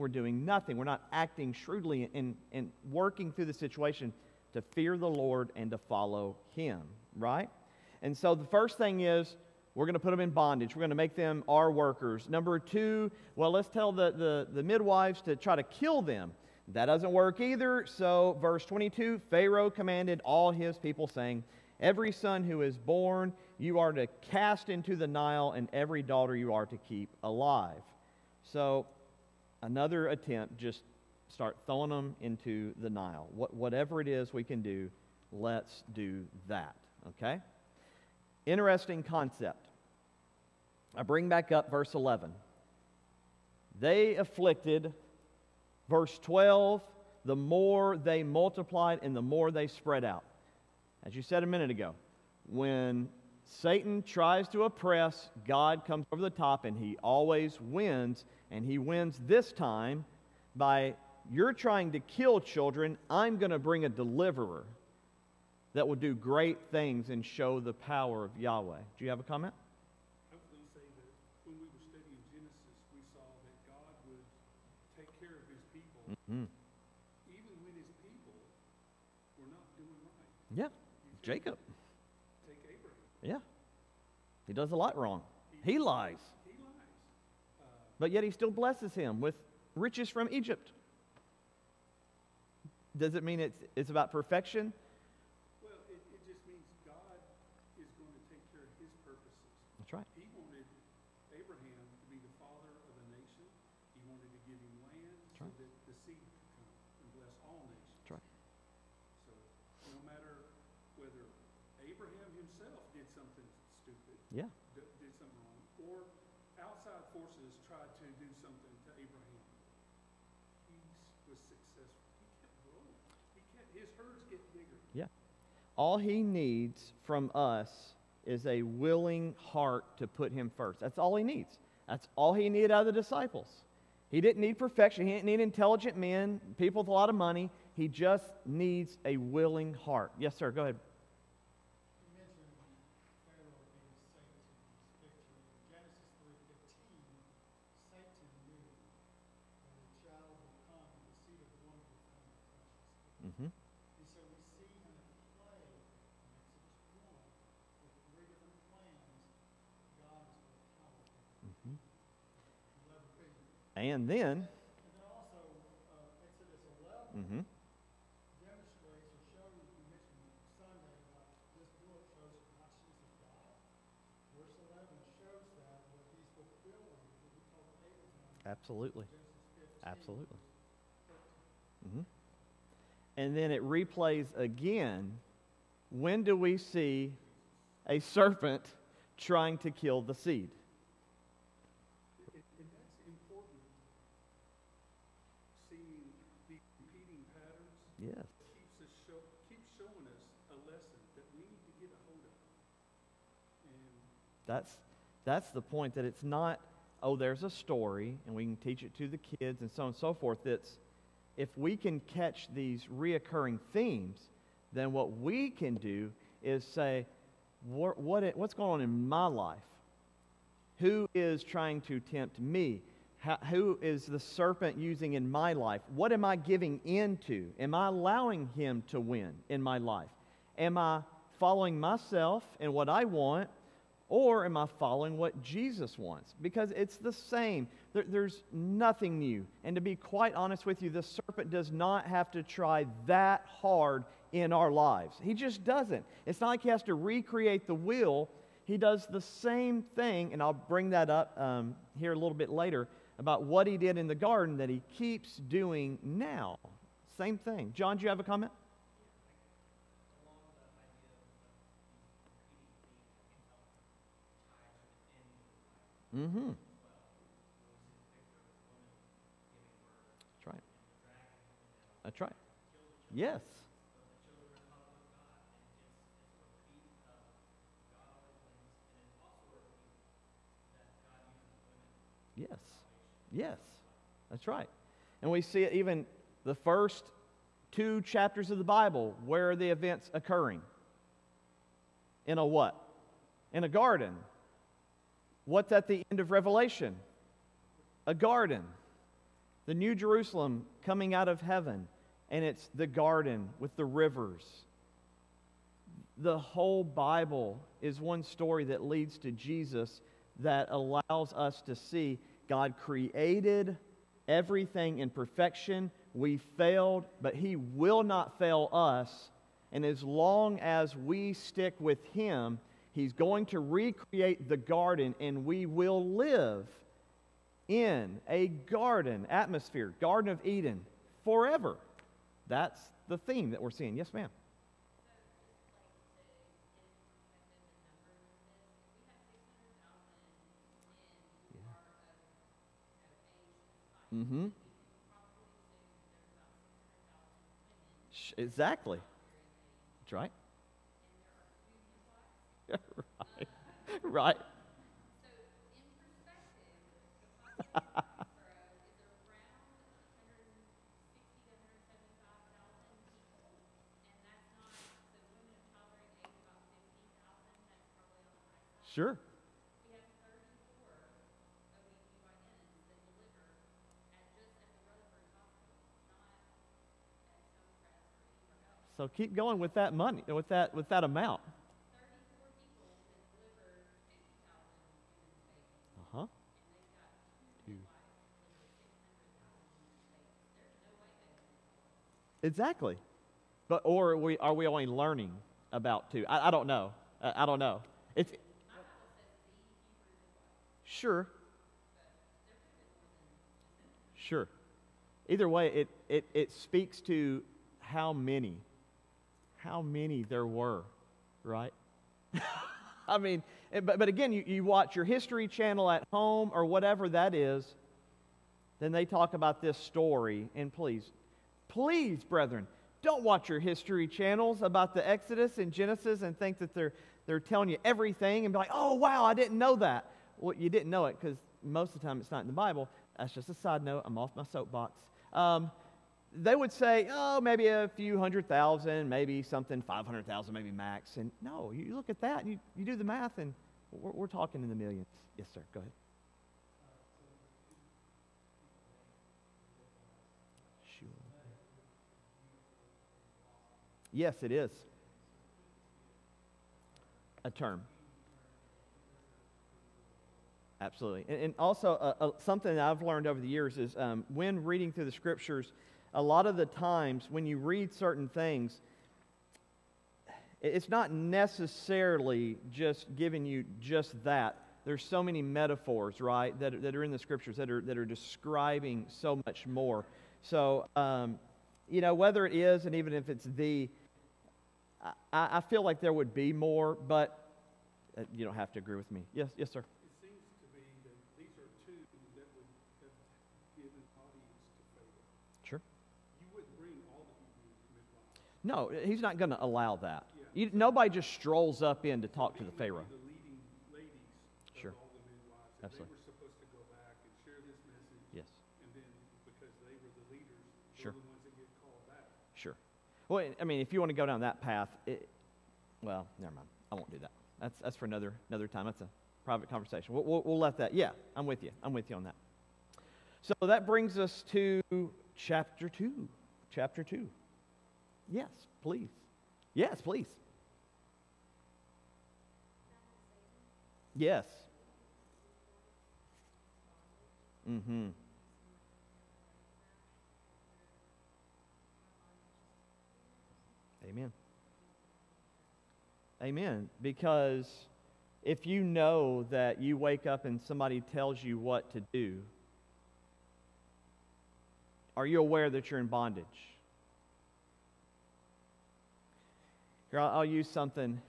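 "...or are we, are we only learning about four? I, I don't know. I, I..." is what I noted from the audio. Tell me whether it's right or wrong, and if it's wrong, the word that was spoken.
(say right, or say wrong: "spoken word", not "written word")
wrong: "two", not "four".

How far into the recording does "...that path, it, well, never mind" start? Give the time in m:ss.
8:34.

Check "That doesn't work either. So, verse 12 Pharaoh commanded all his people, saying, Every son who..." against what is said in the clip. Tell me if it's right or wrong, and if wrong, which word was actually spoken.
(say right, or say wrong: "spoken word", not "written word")
wrong: "22", not "12".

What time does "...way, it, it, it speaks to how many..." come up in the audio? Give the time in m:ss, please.
6:45.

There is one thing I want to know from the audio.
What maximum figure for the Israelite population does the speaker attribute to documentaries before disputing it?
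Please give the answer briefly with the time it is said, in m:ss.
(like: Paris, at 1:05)
500,000, at 7:19.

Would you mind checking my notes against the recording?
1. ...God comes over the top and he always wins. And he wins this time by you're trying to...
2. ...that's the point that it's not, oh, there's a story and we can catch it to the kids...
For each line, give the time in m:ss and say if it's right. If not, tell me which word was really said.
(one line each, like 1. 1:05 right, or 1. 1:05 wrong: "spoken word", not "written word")
1. 0:55 right
2. 3:25 wrong: "teach", not "catch".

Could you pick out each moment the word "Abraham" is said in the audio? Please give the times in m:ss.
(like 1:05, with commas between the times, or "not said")
1:22.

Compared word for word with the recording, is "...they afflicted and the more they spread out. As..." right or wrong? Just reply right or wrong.
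wrong.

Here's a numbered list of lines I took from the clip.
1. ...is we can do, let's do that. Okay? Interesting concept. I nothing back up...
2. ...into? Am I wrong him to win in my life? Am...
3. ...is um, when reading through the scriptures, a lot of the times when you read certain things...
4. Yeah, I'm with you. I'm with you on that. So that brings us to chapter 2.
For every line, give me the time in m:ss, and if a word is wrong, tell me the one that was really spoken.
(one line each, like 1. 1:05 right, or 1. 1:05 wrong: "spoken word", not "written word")
1. 0:34 wrong: "bring", not "nothing"
2. 3:46 wrong: "allowing", not "wrong"
3. 7:43 right
4. 8:40 right.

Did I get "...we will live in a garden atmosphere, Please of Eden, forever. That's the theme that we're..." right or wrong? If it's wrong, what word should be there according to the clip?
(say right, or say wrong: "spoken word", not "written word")
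wrong: "Garden", not "Please".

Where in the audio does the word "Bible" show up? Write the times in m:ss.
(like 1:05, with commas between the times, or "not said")
4:48, 5:06, 7:12.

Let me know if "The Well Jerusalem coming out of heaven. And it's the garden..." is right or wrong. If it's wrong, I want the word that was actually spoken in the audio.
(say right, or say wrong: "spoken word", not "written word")
wrong: "New", not "Well".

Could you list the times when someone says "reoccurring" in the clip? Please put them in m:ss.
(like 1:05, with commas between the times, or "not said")
3:32.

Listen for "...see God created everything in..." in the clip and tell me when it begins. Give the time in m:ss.
5:11.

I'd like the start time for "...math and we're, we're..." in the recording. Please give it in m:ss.
7:23.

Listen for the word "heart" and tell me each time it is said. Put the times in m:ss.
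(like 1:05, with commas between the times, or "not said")
2:09, 2:19.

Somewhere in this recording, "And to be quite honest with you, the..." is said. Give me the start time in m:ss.
3:59.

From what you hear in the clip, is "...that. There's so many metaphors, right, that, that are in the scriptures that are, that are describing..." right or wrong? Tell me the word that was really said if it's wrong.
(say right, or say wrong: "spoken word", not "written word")
right.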